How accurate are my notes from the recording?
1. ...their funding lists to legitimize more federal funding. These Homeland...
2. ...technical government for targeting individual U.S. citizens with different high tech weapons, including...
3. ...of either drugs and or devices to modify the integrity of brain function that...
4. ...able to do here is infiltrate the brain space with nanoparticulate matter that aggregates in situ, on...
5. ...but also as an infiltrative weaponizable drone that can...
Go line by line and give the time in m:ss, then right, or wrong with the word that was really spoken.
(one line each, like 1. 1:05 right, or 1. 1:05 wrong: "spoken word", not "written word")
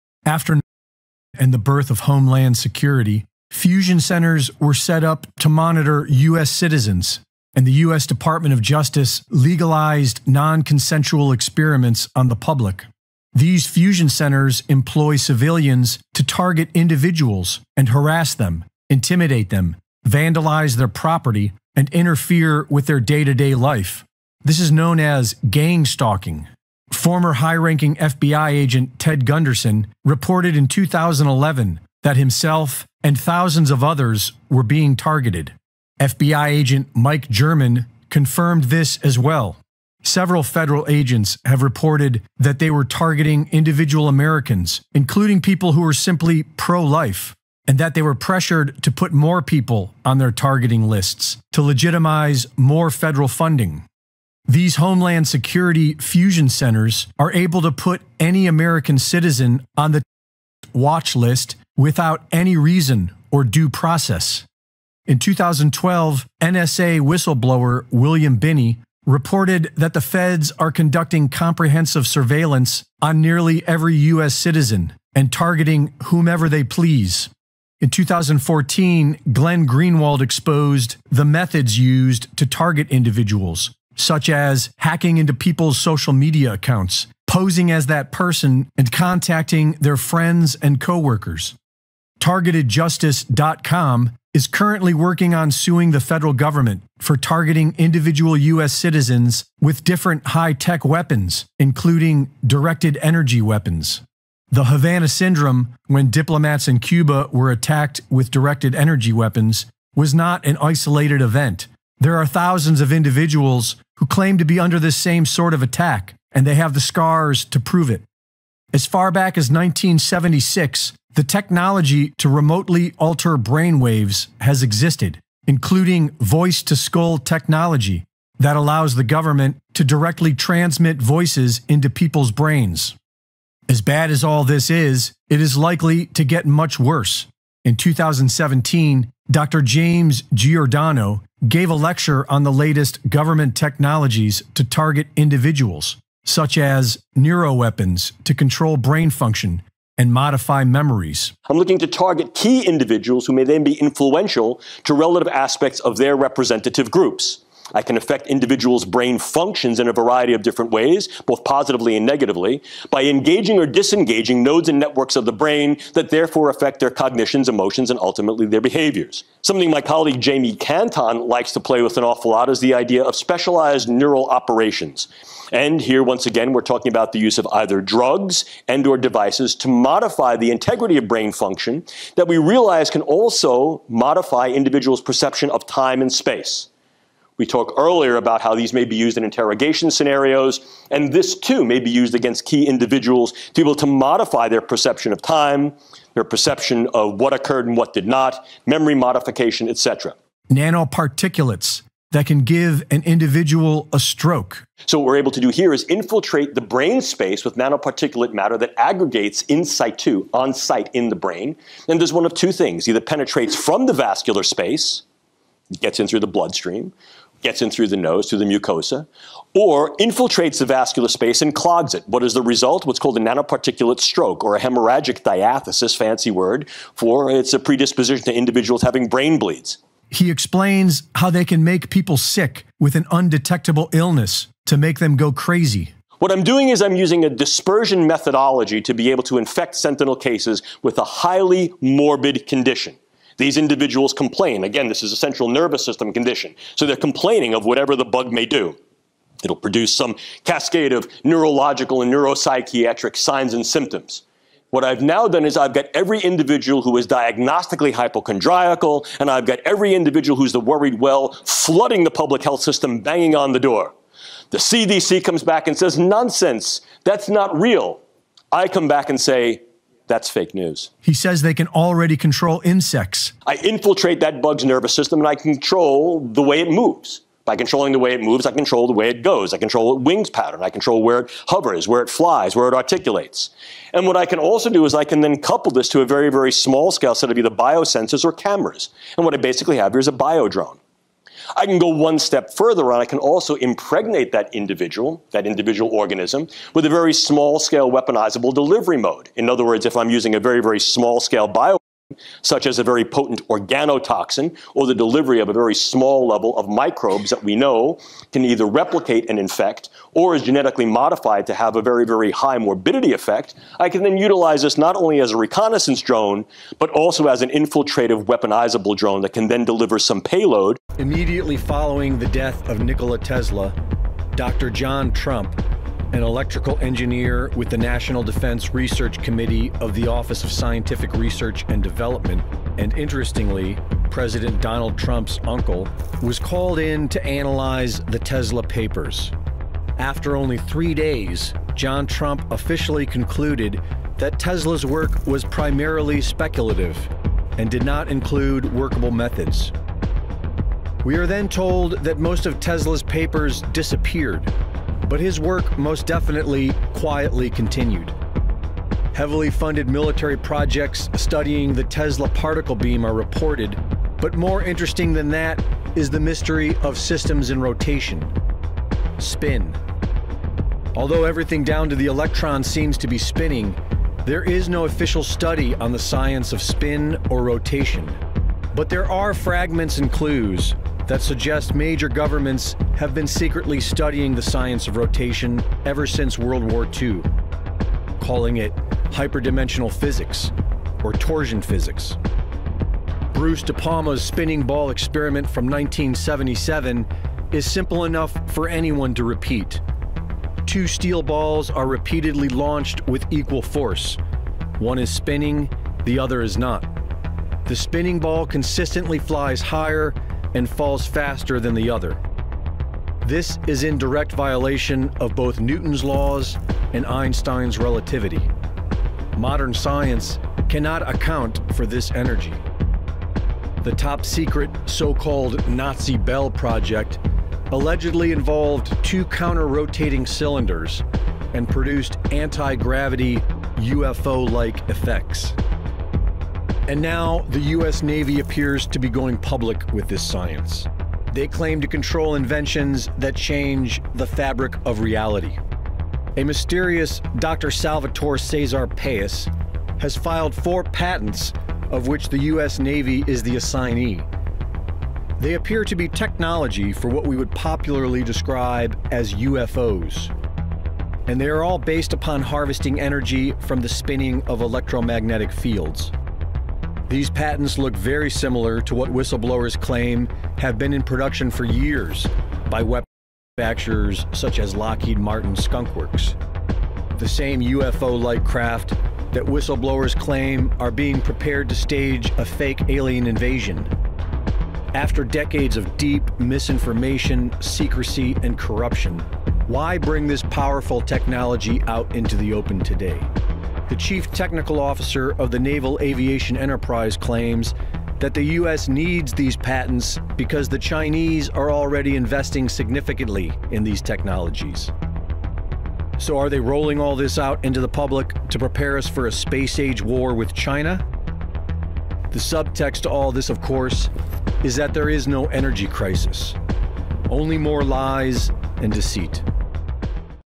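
1. 0:50 wrong: "targeting", not "funding"
2. 1:35 wrong: "federal", not "technical"
3. 2:57 right
4. 3:25 right
5. 5:16 right.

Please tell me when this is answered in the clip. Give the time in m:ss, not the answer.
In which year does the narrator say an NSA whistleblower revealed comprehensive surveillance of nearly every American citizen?
1:05.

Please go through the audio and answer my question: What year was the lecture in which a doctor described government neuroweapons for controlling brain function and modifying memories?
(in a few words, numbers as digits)
2017.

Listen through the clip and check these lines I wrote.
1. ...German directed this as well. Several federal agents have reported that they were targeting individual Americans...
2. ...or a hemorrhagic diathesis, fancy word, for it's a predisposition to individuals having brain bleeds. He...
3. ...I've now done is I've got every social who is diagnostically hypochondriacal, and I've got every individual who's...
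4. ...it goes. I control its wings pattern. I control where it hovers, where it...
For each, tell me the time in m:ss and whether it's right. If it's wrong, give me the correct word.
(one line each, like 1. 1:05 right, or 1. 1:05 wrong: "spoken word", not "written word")
1. 0:37 wrong: "confirmed", not "directed"
2. 3:44 right
3. 4:14 wrong: "individual", not "social"
4. 4:39 right.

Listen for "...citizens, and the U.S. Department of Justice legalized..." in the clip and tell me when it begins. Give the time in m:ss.
0:06.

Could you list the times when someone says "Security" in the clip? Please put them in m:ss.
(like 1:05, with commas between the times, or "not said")
0:02, 0:55.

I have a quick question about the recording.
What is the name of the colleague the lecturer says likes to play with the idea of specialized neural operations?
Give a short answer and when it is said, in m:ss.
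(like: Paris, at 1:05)
Jamie Canton, at 2:50.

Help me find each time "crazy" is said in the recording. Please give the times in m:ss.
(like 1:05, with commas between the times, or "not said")
3:55.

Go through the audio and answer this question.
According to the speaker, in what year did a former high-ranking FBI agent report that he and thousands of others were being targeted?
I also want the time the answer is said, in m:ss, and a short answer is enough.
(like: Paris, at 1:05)
2011, at 0:30.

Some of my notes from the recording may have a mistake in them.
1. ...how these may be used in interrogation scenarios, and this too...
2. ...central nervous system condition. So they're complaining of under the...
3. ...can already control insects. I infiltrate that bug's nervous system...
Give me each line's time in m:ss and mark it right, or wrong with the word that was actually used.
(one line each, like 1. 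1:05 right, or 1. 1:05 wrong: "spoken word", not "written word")
1. 3:08 right
2. 4:05 wrong: "whatever", not "under"
3. 4:31 right.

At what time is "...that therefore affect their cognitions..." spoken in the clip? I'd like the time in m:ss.
2:45.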